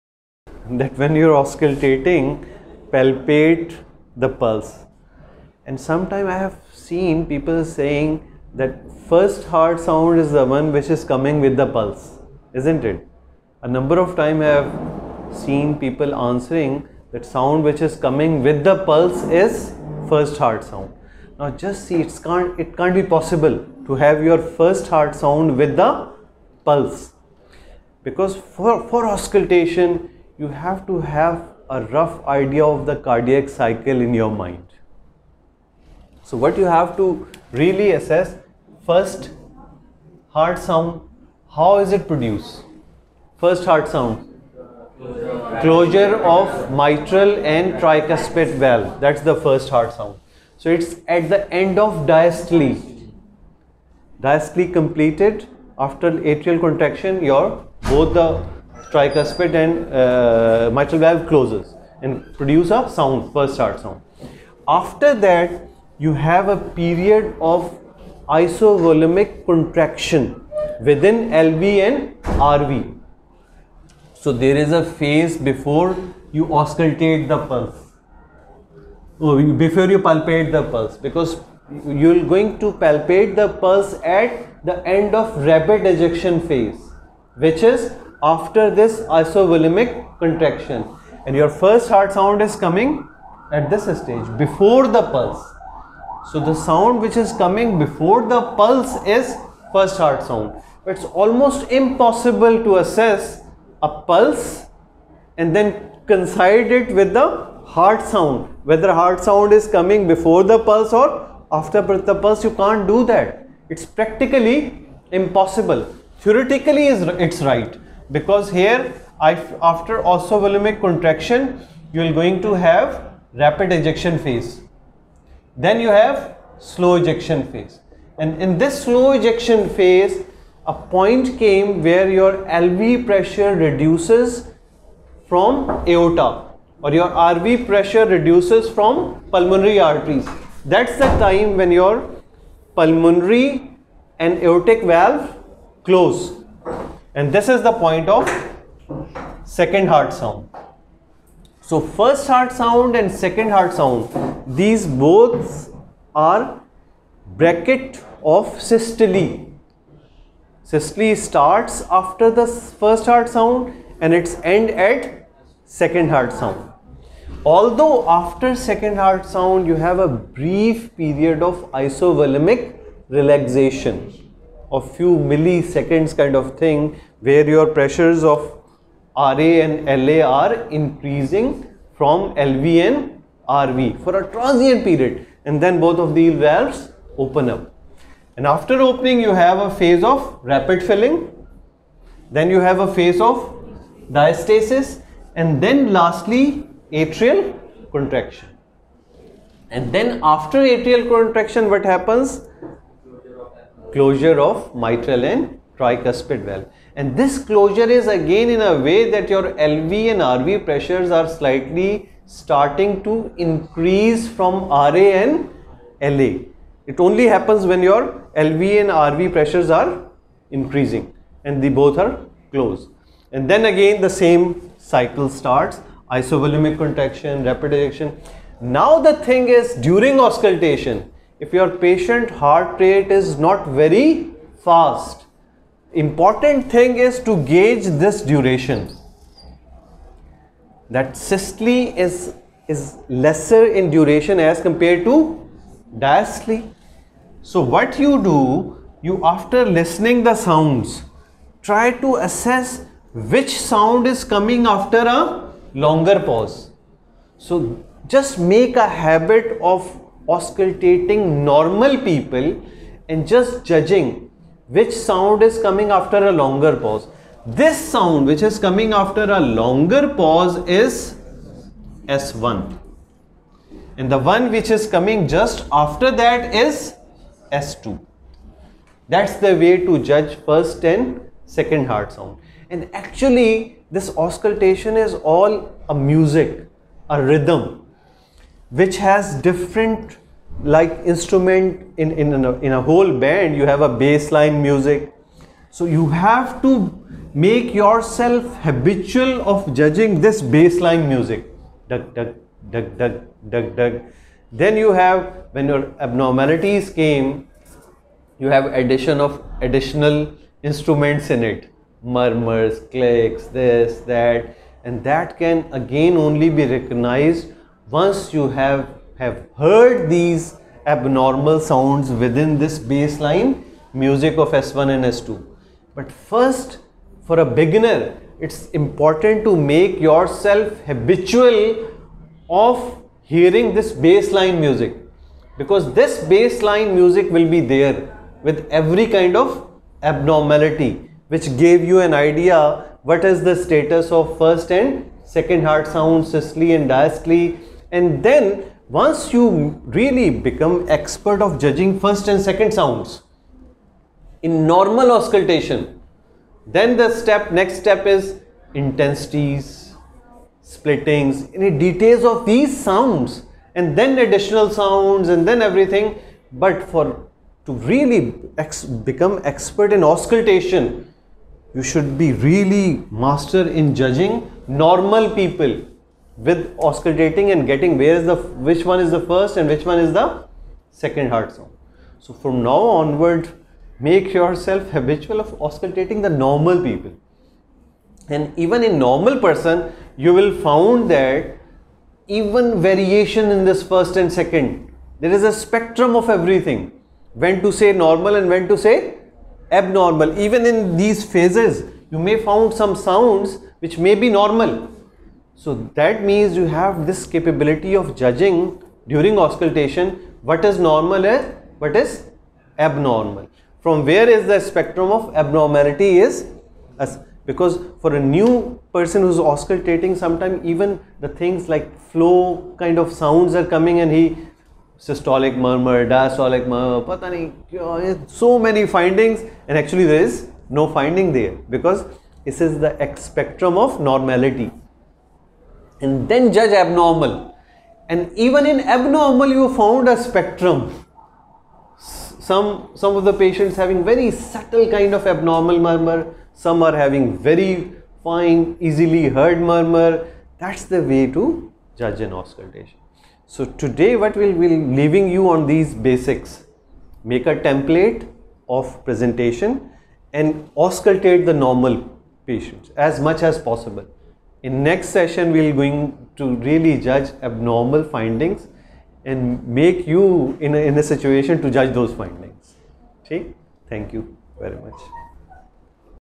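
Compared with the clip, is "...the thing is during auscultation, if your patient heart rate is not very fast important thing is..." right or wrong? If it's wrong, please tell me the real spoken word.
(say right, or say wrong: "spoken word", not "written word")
right.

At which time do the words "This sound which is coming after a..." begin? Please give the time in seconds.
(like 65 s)
267 s.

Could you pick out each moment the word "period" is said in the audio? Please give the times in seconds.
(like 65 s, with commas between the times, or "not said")
66 s, 171 s, 184 s.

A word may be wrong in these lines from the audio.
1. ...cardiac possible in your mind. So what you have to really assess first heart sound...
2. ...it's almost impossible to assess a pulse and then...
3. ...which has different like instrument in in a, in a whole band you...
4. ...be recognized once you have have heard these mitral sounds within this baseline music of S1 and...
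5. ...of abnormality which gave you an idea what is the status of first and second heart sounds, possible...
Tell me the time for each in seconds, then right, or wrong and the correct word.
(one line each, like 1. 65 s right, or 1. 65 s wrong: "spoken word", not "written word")
1. 33 s wrong: "cycle", not "possible"
2. 100 s right
3. 288 s right
4. 316 s wrong: "abnormal", not "mitral"
5. 339 s wrong: "systole", not "possible".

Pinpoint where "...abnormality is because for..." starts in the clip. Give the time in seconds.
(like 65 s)
415 s.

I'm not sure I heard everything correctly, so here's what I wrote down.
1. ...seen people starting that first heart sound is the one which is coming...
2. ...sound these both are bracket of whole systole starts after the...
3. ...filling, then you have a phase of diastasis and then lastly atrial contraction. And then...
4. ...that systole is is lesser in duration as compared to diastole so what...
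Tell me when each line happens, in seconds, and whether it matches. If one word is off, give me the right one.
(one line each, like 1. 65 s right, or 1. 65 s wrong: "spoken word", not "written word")
1. 6 s wrong: "saying", not "starting"
2. 153 s wrong: "systole", not "whole"
3. 190 s right
4. 240 s right.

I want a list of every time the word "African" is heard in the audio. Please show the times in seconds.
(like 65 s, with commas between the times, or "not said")
not said.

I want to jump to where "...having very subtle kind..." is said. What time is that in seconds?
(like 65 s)
443 s.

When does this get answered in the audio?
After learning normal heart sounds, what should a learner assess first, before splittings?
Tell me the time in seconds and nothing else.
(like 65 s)
358 s.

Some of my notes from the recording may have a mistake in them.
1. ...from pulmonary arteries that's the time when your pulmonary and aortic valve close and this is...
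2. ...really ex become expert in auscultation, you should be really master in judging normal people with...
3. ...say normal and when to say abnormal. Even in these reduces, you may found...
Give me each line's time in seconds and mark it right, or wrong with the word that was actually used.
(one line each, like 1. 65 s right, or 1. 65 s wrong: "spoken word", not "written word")
1. 138 s right
2. 367 s right
3. 397 s wrong: "phases", not "reduces".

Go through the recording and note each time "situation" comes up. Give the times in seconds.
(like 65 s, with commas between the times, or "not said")
471 s.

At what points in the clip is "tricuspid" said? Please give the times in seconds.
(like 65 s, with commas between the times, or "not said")
47 s, 58 s, 205 s.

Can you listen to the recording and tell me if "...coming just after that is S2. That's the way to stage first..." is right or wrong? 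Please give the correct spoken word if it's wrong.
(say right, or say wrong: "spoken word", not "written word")
wrong: "judge", not "stage".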